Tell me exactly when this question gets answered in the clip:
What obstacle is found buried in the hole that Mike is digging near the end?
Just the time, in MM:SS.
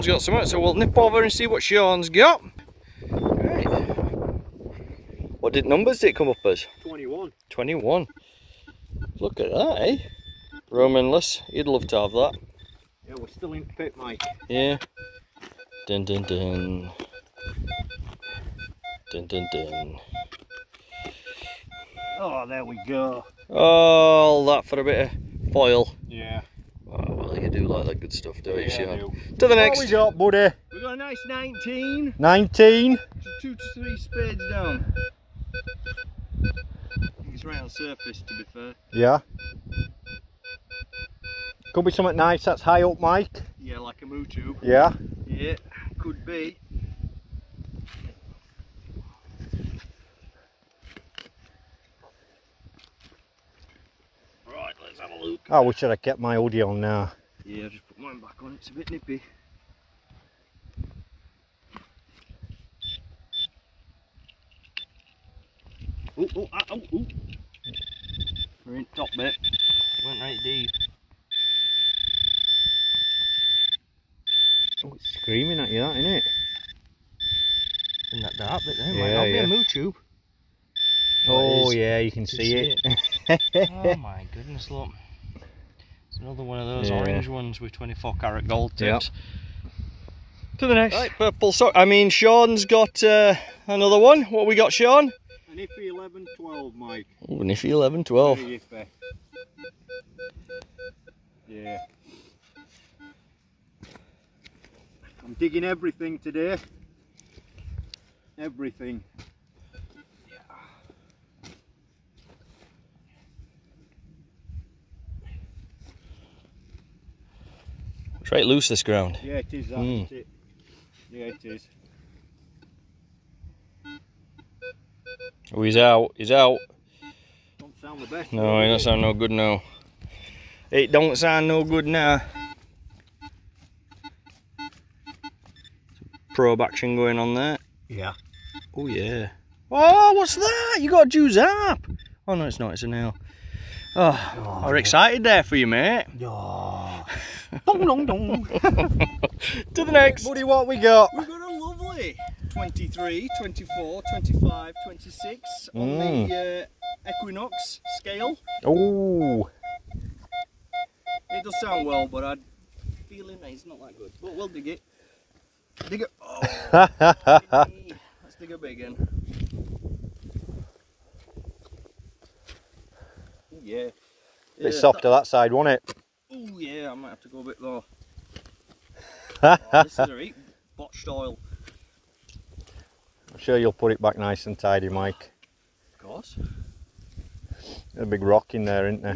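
03:08.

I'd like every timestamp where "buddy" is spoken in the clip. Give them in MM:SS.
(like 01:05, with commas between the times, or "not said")
00:30, 02:30.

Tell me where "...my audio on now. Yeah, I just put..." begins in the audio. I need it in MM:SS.
00:56.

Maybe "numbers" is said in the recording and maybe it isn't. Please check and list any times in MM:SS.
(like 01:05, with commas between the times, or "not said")
00:05.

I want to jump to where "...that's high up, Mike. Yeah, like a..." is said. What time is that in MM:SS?
00:42.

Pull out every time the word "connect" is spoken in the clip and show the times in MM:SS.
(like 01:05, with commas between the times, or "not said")
not said.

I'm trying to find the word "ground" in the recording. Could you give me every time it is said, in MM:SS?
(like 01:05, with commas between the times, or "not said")
01:58.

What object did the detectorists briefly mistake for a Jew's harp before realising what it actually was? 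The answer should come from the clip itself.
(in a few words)
a nail.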